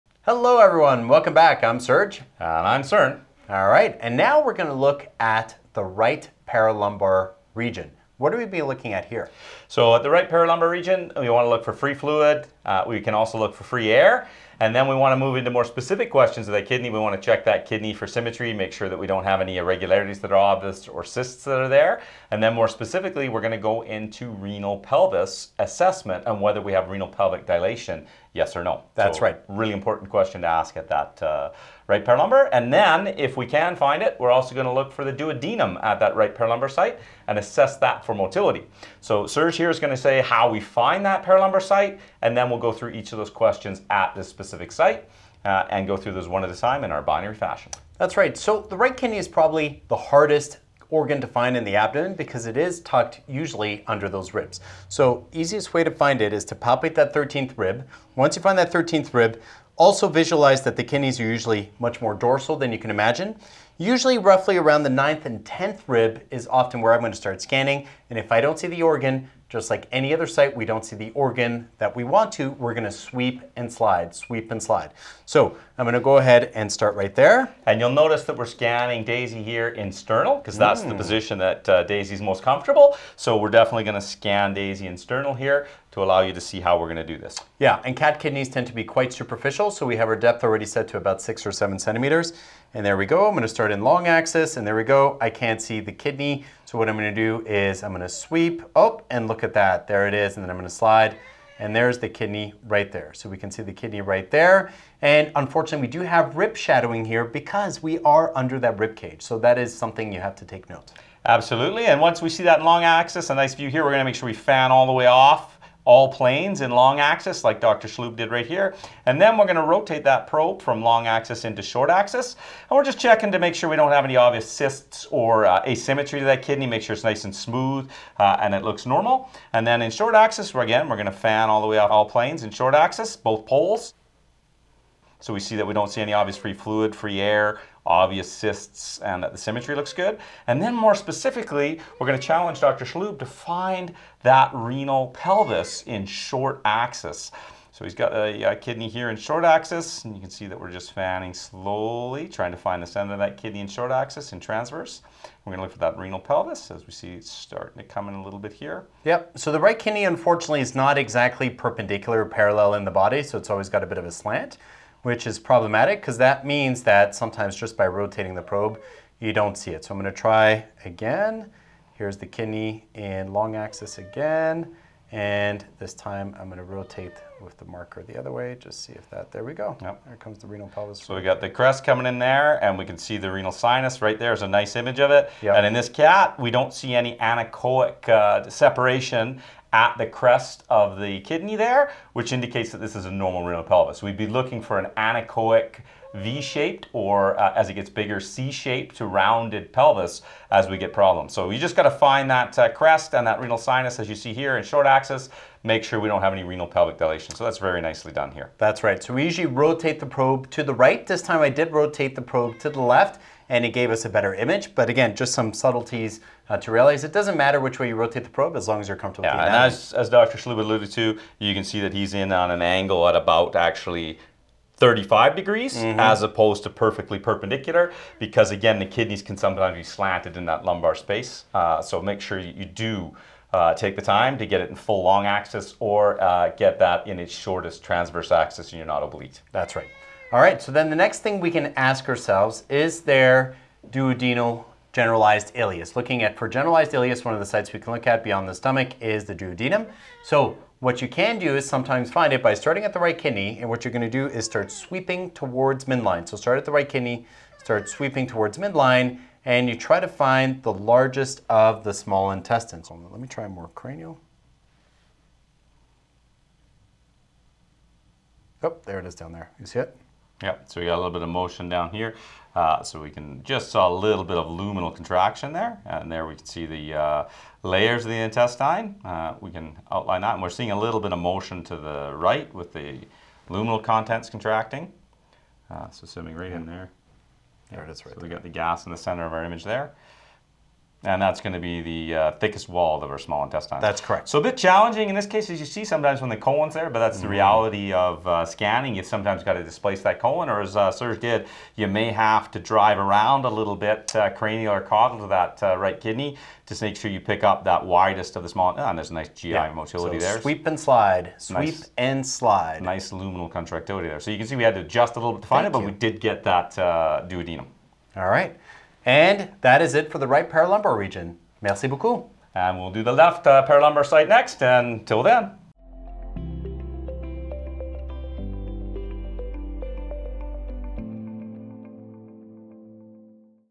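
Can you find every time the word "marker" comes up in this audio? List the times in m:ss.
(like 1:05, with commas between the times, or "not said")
2:57.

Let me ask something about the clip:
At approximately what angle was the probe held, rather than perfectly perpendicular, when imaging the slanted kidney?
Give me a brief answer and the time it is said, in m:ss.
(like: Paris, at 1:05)
35 degrees, at 3:44.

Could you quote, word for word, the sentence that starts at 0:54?
So easiest way to find it is to palpate that 13th rib.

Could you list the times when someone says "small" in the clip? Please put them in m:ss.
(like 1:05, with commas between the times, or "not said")
4:21, 4:53, 5:08.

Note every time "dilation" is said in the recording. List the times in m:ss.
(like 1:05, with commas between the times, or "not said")
0:27, 3:26.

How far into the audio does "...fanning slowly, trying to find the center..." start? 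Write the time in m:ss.
2:30.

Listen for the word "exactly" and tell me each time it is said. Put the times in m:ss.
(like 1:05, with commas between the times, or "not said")
2:40.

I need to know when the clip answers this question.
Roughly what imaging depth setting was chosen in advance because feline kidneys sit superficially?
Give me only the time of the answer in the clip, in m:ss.
1:31.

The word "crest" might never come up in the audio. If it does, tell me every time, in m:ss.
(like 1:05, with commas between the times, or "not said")
3:01, 3:10, 3:22.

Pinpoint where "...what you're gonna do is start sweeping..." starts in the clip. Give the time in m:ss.
4:13.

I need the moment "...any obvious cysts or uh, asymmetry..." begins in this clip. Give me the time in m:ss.
2:04.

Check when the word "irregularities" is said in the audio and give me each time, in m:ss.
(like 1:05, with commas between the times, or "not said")
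0:19.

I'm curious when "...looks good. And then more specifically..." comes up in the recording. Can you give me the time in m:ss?
2:19.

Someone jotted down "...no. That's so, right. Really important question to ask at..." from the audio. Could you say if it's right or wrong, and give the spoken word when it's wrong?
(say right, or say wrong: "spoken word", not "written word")
right.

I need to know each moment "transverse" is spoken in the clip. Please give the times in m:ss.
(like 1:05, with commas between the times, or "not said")
2:34, 3:57.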